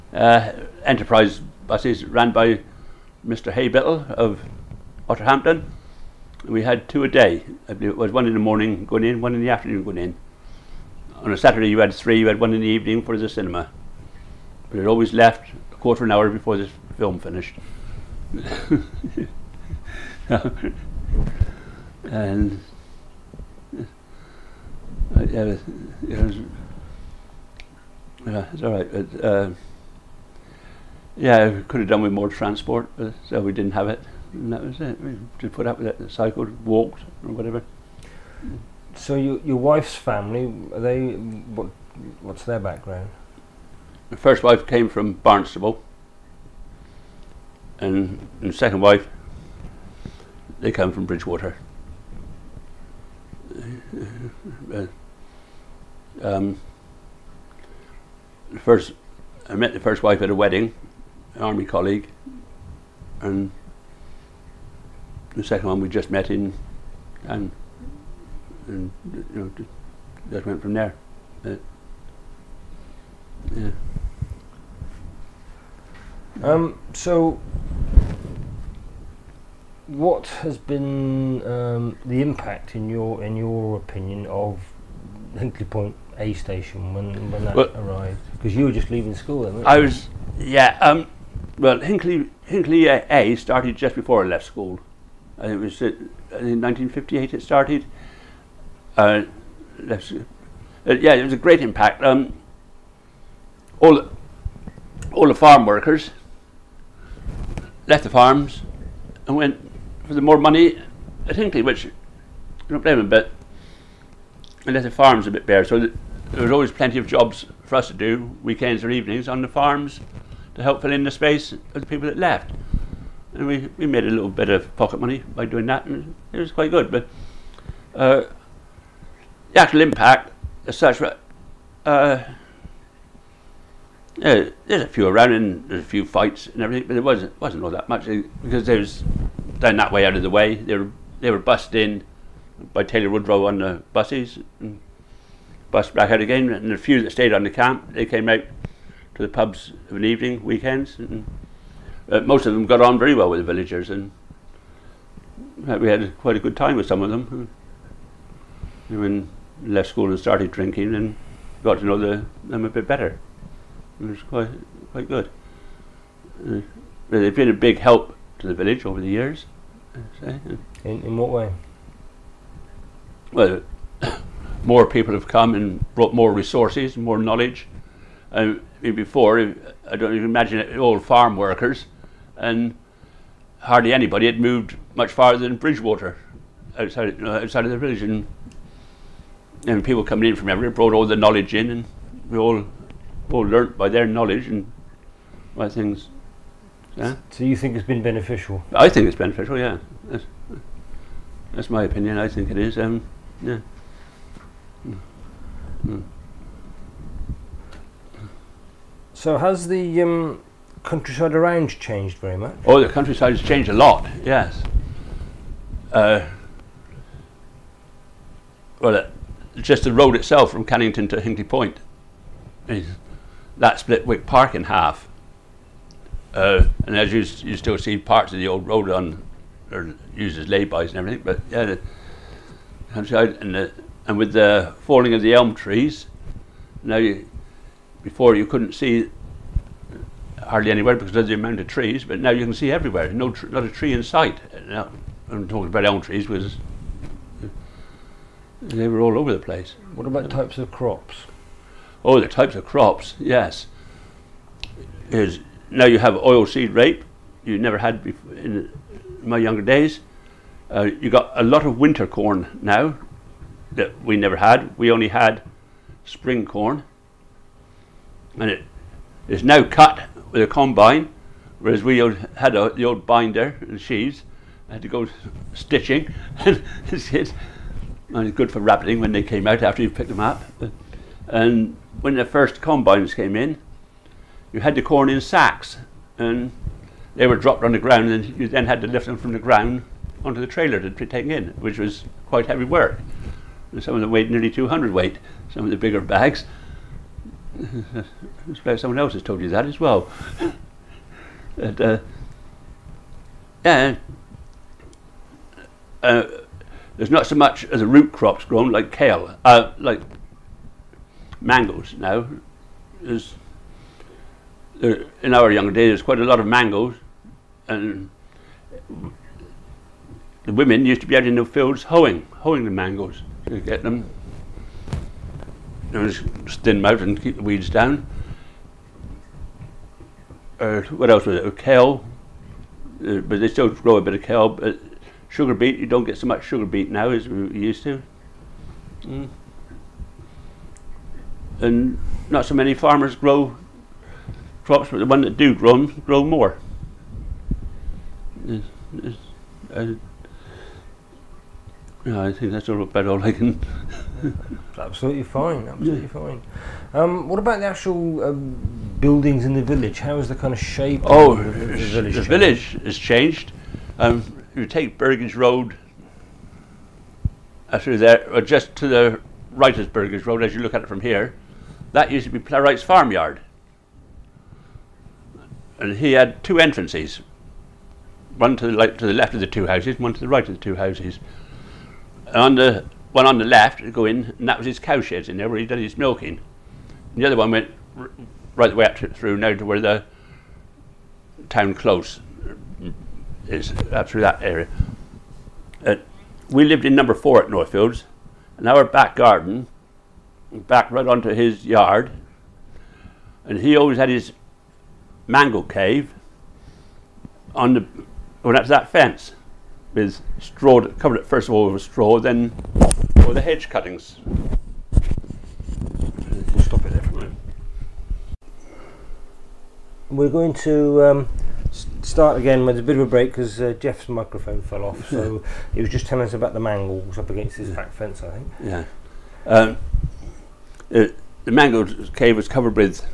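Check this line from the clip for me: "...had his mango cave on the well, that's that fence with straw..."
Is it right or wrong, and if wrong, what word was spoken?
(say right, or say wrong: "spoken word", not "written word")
right.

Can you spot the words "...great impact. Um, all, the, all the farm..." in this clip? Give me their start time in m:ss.
1:41.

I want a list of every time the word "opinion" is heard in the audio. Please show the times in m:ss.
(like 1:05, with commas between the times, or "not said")
1:23, 3:21.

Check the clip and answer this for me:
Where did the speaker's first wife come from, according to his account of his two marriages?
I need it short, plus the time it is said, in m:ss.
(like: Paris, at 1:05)
Barnstaple, at 0:45.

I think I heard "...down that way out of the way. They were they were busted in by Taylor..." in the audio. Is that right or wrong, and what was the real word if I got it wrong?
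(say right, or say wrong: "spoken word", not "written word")
right.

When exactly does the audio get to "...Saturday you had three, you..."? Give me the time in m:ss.
0:11.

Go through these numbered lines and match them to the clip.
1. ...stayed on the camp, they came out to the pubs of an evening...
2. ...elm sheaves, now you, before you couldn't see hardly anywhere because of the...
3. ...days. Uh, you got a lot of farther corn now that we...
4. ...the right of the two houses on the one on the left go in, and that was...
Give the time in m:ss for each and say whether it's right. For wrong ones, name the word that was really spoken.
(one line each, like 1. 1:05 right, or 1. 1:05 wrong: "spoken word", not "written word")
1. 2:27 right
2. 3:55 wrong: "trees", not "sheaves"
3. 4:19 wrong: "winter", not "farther"
4. 6:20 right.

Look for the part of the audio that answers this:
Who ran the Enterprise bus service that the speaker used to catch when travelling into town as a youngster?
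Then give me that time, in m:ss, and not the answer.
0:03.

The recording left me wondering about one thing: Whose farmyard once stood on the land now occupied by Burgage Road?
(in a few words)
Plowright's.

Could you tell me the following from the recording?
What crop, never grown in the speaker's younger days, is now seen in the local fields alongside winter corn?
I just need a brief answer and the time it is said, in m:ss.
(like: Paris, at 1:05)
Oilseed rape, at 4:16.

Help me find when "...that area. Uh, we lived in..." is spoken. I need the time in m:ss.
6:34.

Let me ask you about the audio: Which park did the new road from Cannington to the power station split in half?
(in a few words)
Wick Park.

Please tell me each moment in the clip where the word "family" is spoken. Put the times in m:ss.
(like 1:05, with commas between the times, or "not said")
0:39.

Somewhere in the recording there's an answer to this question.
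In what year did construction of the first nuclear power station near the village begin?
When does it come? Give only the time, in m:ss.
1:36.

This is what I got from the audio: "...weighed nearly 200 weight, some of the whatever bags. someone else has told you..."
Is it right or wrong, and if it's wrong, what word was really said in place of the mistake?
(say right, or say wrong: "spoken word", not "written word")
wrong: "bigger", not "whatever".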